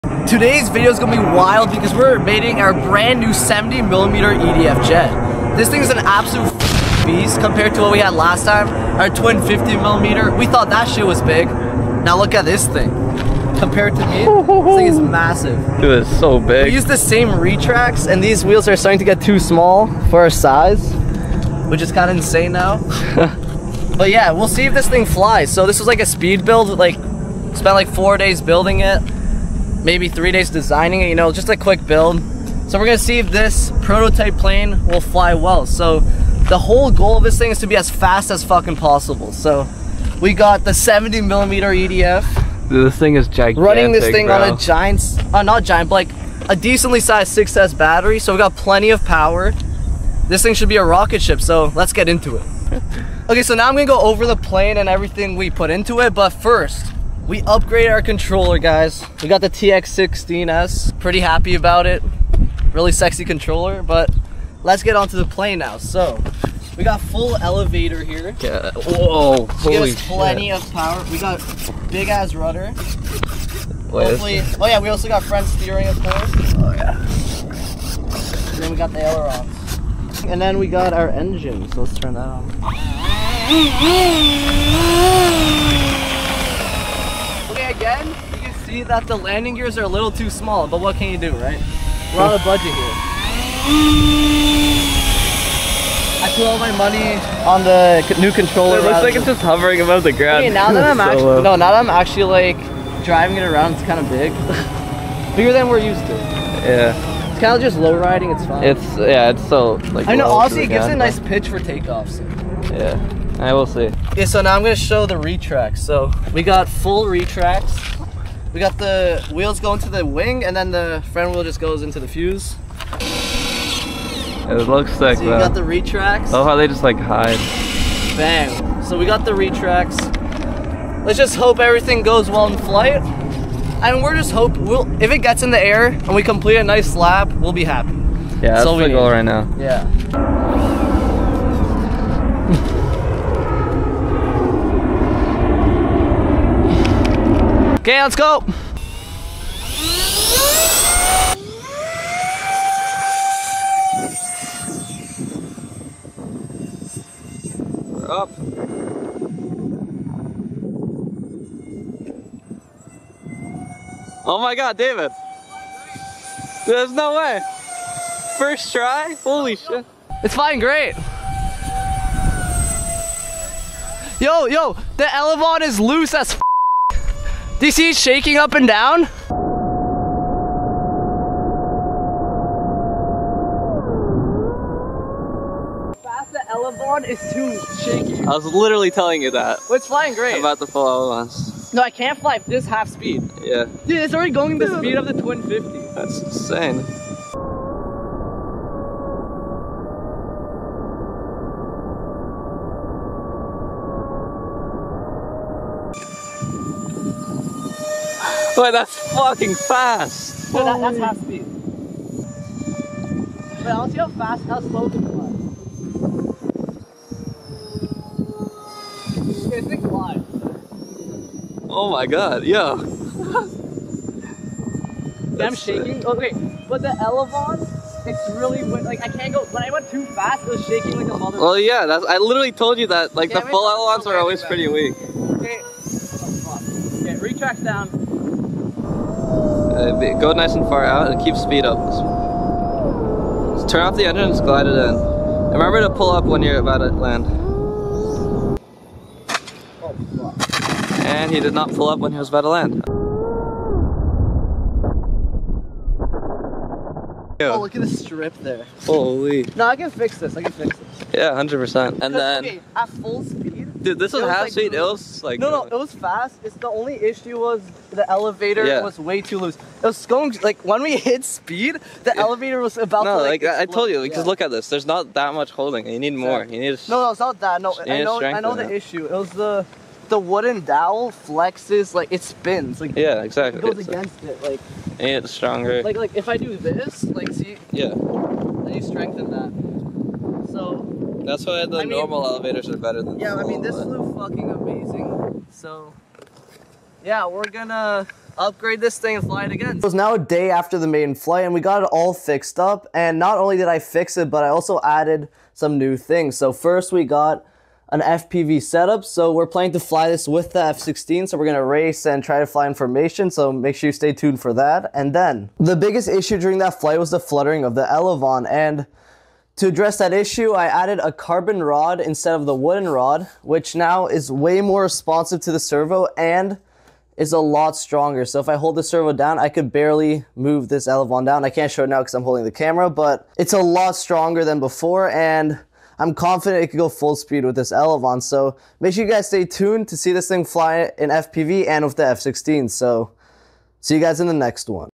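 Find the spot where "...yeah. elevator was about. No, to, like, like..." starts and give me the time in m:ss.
4:32.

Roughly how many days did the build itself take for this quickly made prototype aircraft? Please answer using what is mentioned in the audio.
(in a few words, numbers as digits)
4.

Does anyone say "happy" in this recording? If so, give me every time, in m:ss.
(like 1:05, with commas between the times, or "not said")
1:01, 2:17.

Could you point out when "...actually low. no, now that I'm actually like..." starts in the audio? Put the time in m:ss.
1:41.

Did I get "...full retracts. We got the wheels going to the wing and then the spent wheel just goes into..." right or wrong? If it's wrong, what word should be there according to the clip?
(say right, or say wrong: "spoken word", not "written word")
wrong: "front", not "spent".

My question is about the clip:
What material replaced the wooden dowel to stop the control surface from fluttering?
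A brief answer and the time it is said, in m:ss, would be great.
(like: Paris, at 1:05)
carbon rod, at 5:21.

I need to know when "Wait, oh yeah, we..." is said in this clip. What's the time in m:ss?
1:13.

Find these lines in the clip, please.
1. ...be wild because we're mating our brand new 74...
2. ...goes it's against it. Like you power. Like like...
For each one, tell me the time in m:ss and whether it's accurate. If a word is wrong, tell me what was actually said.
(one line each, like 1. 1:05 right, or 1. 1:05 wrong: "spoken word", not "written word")
1. 0:01 wrong: "70", not "74"
2. 4:43 wrong: "stronger", not "power".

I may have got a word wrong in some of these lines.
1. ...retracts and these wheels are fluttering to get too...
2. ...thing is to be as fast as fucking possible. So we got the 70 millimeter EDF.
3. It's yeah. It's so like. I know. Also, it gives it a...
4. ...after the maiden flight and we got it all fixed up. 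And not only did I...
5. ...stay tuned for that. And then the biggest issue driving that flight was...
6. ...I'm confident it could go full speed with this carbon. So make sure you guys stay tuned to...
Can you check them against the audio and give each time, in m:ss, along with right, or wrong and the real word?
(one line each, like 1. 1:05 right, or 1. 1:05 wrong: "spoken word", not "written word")
1. 0:17 wrong: "starting", not "fluttering"
2. 0:37 right
3. 1:48 right
4. 5:00 right
5. 5:13 wrong: "during", not "driving"
6. 5:35 wrong: "elevon", not "carbon".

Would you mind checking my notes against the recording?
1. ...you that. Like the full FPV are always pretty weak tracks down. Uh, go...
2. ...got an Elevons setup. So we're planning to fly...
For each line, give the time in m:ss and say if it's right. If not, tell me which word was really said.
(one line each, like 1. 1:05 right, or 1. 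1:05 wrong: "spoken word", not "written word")
1. 3:52 wrong: "Elevons", not "FPV"
2. 5:07 wrong: "FPV", not "Elevons".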